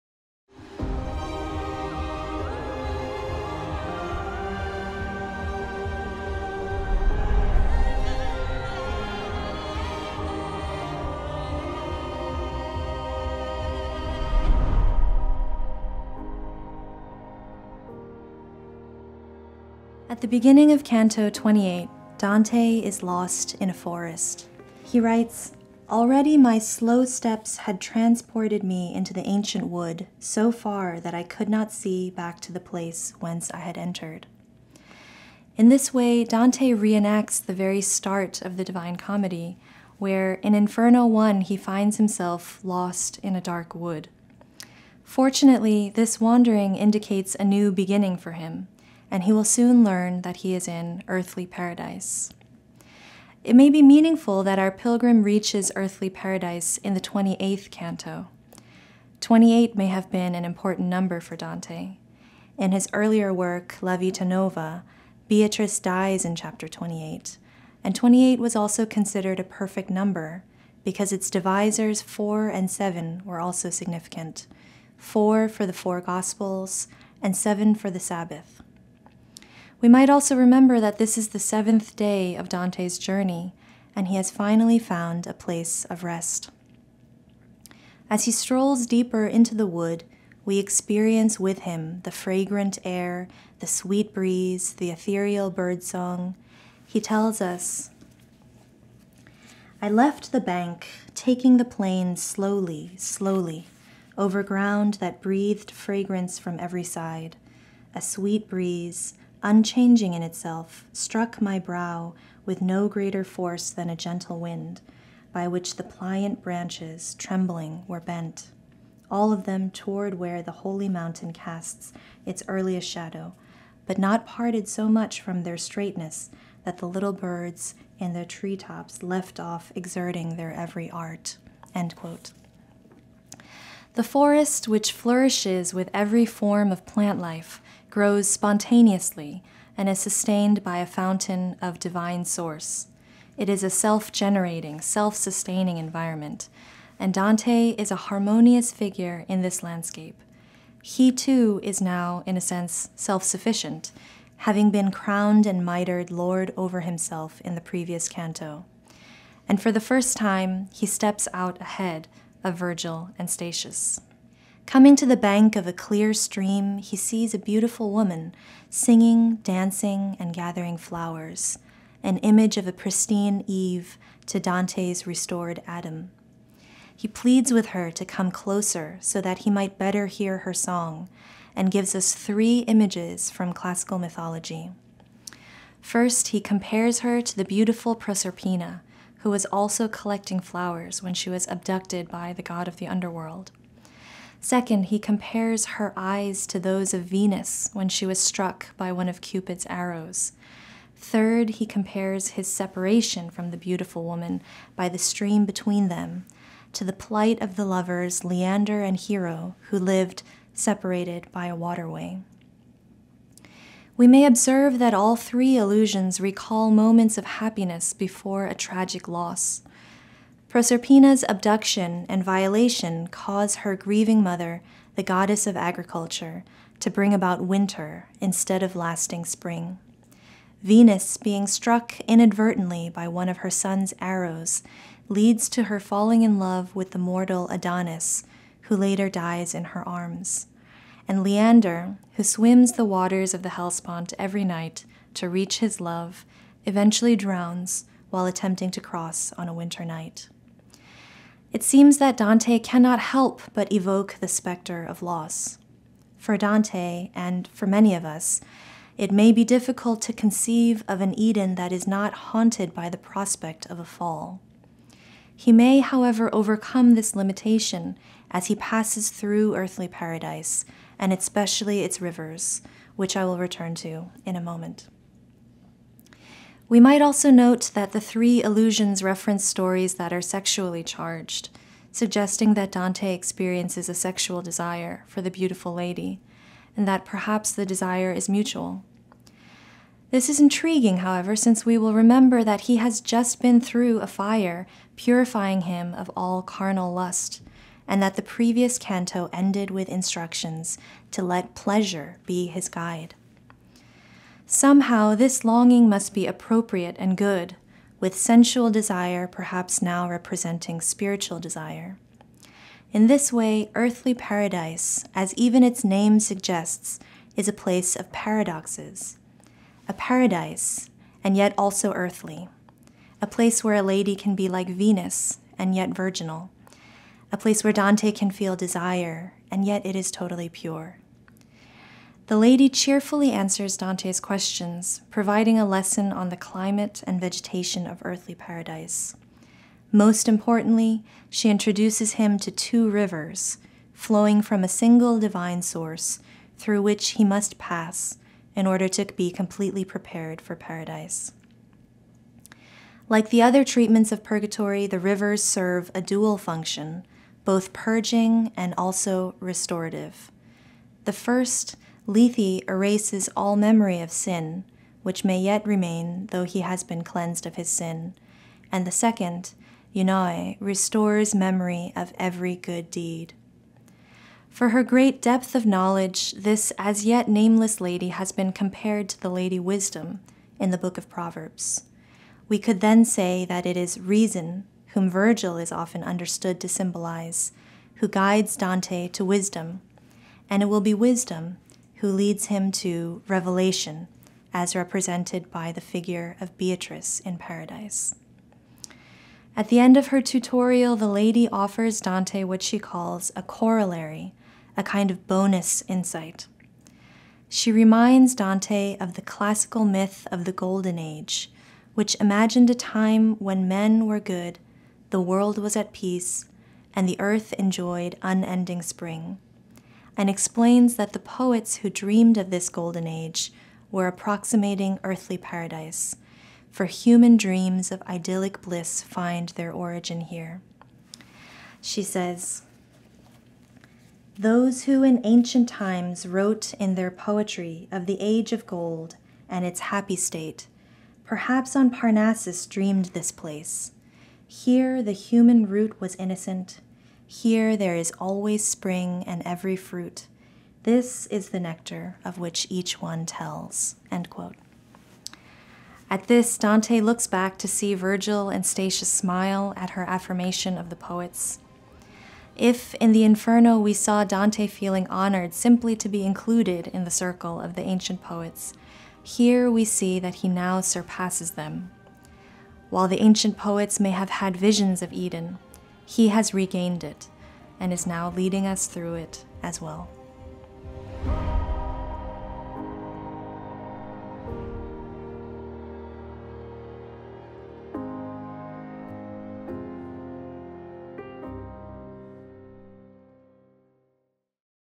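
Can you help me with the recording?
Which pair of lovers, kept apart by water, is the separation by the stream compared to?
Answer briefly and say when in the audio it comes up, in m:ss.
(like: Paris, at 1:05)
Leander and Hero, at 3:28.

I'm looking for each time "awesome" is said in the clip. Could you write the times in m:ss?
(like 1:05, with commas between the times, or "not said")
not said.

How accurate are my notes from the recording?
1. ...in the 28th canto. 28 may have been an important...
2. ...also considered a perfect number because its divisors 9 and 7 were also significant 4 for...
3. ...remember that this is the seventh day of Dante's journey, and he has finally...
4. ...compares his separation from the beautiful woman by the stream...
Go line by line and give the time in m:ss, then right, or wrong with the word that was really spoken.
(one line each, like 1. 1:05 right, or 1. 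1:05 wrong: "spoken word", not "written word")
1. 0:56 right
2. 1:08 wrong: "4", not "9"
3. 1:20 right
4. 3:21 right.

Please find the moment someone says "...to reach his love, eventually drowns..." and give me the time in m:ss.
4:05.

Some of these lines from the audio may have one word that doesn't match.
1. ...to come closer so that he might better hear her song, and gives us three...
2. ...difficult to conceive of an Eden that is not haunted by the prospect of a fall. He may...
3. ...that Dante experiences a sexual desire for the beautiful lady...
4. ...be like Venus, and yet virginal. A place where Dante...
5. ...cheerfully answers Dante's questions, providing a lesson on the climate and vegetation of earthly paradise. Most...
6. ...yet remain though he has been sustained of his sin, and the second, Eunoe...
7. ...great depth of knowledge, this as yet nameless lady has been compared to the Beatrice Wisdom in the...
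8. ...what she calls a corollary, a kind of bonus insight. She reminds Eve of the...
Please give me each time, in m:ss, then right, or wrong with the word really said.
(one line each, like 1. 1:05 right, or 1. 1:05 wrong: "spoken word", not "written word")
1. 2:57 right
2. 4:19 right
3. 4:42 right
4. 5:24 right
5. 5:32 right
6. 6:05 wrong: "cleansed", not "sustained"
7. 6:14 wrong: "Lady", not "Beatrice"
8. 6:42 wrong: "Dante", not "Eve".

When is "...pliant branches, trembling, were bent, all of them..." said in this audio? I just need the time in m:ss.
1:55.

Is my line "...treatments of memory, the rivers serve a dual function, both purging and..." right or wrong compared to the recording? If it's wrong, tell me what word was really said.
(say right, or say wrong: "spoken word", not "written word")
wrong: "purgatory", not "memory".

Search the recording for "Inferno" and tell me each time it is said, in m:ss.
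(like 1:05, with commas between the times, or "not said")
0:40, 7:43.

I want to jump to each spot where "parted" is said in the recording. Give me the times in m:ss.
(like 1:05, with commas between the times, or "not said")
2:04.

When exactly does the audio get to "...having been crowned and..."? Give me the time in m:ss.
2:34.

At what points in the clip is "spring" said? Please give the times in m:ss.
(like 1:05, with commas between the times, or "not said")
3:49, 6:58, 7:28.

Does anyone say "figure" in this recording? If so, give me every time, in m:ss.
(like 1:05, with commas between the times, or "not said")
2:28, 6:35.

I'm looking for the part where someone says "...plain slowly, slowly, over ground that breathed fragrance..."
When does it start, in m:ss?
1:41.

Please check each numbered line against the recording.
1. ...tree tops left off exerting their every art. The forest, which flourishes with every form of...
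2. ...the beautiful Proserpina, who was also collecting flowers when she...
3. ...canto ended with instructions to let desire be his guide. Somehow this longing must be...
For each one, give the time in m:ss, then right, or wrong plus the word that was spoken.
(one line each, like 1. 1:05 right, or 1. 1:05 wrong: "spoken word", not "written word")
1. 2:08 right
2. 3:07 right
3. 4:58 wrong: "pleasure", not "desire".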